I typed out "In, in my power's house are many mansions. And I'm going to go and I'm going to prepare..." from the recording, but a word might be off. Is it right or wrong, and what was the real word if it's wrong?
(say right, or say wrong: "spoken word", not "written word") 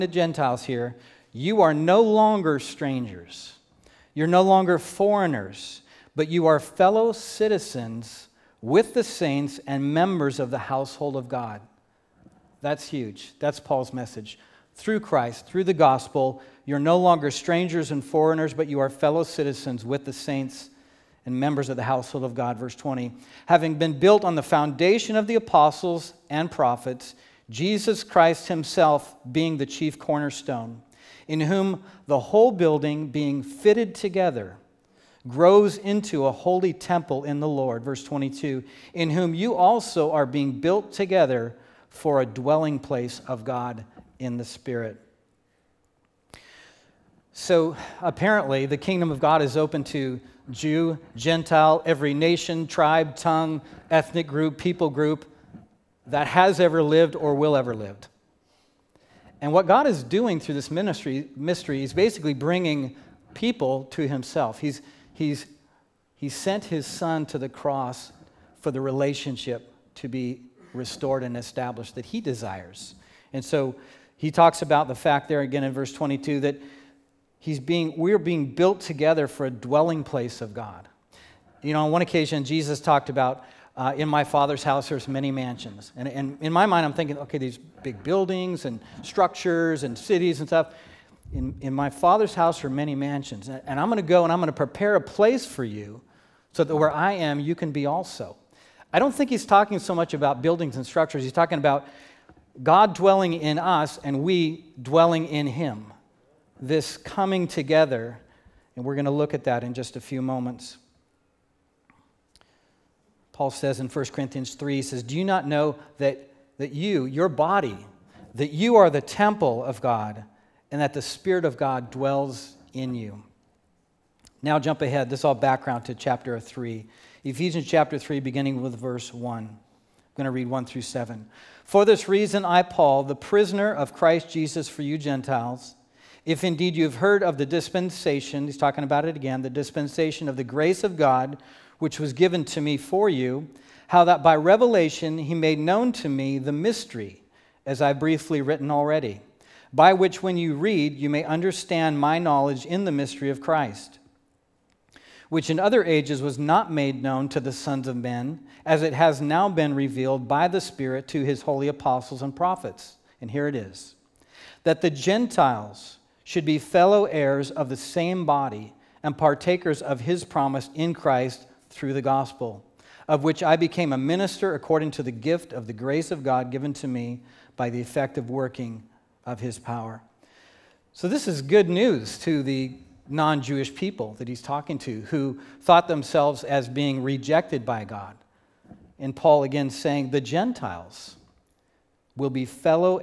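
wrong: "father", not "power".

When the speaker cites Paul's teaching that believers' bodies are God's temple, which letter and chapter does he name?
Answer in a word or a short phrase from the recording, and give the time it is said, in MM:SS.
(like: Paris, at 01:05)
1 Corinthians 3, at 01:53.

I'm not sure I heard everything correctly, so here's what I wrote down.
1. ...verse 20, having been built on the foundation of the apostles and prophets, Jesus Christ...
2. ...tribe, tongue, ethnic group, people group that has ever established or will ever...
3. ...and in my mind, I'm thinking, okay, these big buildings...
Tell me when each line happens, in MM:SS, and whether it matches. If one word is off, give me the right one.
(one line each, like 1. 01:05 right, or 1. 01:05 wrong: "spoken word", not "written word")
1. 00:22 right
2. 00:52 wrong: "lived", not "established"
3. 01:26 right.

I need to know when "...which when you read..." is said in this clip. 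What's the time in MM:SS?
02:29.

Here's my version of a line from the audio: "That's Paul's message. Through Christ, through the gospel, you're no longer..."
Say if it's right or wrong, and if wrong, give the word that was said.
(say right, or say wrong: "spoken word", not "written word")
right.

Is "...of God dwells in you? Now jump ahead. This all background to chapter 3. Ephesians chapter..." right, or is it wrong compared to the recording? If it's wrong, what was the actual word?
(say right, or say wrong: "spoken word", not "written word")
right.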